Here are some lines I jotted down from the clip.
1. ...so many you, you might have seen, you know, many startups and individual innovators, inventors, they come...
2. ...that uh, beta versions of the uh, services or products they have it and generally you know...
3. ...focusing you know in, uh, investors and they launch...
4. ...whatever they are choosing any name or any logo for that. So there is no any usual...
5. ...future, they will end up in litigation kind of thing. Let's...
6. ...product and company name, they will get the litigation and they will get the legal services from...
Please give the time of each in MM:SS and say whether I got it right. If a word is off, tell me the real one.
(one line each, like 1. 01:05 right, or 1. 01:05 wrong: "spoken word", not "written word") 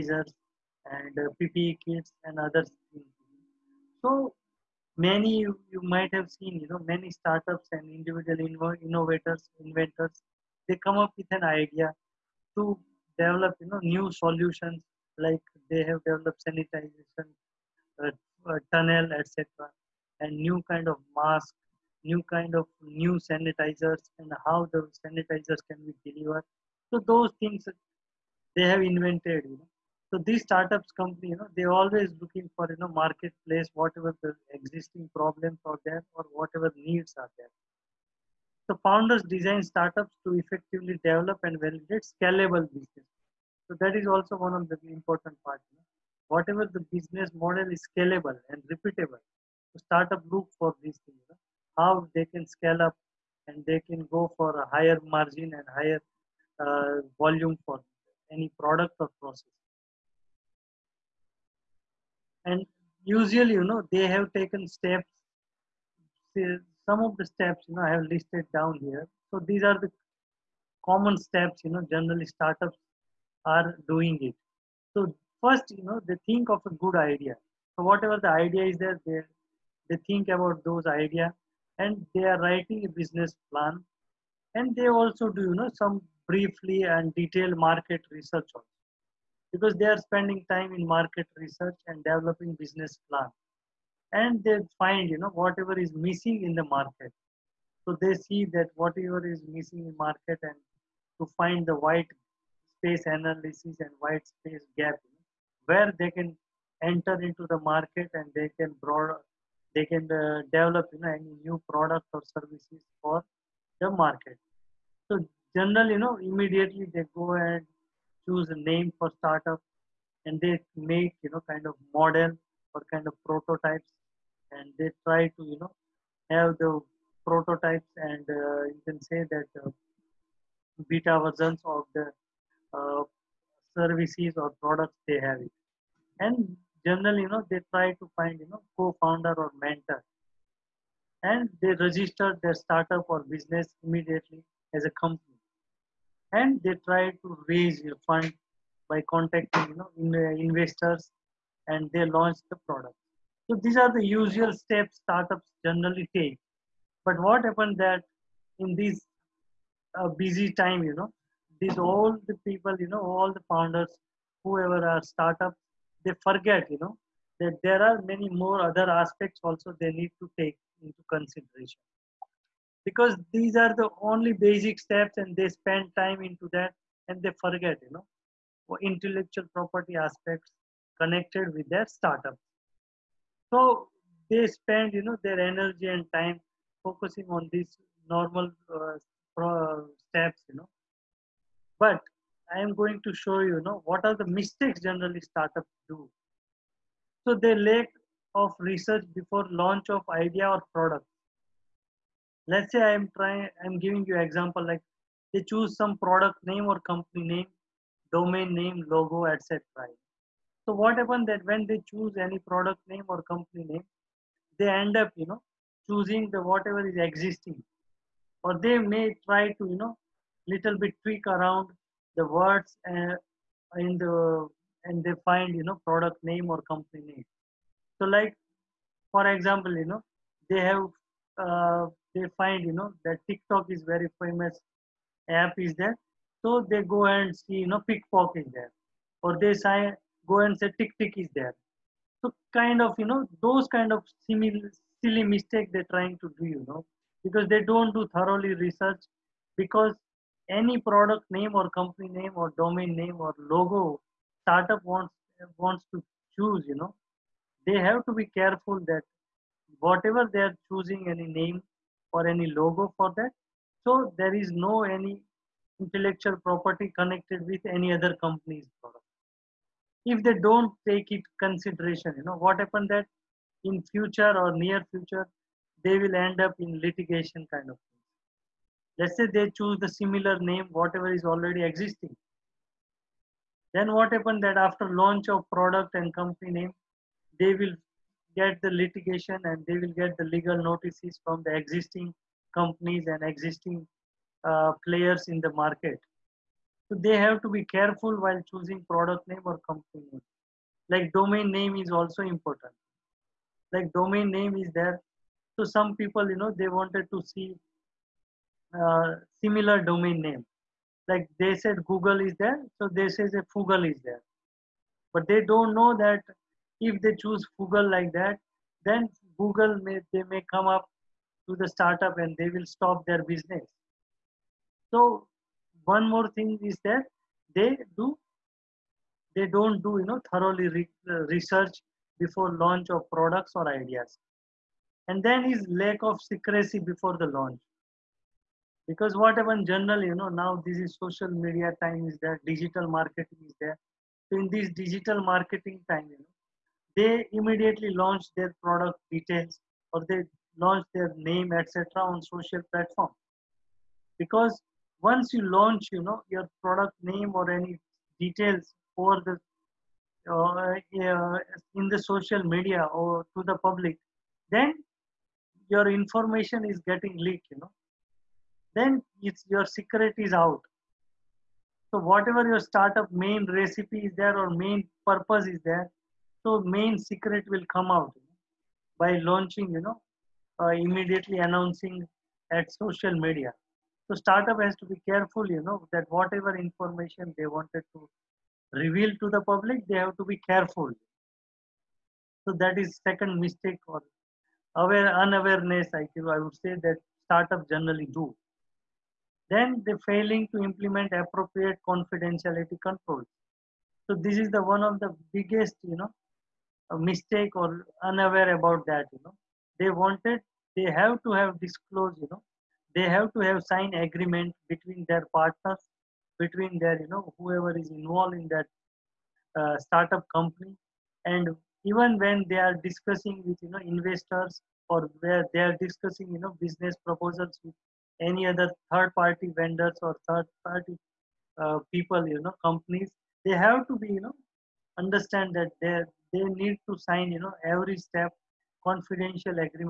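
1. 00:04 right
2. 02:09 right
3. 02:29 wrong: "contacting", not "focusing"
4. 04:19 wrong: "intellectual", not "usual"
5. 04:34 right
6. 04:45 wrong: "notices", not "services".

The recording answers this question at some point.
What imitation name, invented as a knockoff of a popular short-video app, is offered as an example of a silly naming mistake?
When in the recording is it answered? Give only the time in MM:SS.
03:57.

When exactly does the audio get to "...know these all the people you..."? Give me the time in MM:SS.
02:40.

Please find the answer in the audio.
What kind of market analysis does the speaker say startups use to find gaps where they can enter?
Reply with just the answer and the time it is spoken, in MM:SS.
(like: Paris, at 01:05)
white space analysis, at 01:41.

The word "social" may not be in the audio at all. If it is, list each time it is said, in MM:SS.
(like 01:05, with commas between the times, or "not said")
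05:41, 05:52, 06:01, 06:22.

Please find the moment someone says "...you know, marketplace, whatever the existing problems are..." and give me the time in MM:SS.
00:32.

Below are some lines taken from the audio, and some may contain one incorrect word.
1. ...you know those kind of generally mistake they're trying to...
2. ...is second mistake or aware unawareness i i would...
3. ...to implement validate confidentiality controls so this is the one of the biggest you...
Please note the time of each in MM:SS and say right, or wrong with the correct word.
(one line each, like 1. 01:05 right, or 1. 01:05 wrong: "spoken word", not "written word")
1. 04:03 wrong: "silly", not "generally"
2. 06:32 right
3. 06:40 wrong: "appropriate", not "validate".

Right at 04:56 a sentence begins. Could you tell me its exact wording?
So they have to be careful while choosing product name or company name.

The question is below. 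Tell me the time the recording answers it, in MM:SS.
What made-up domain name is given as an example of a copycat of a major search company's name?
05:13.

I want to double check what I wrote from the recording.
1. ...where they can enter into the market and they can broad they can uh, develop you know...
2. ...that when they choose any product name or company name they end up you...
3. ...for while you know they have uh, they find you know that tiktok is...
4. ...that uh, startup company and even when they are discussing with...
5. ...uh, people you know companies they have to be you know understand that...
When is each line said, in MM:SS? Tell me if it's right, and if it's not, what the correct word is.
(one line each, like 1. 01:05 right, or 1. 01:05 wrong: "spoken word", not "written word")
1. 01:45 right
2. 03:31 right
3. 03:49 wrong: "example", not "while"
4. 06:58 right
5. 07:11 right.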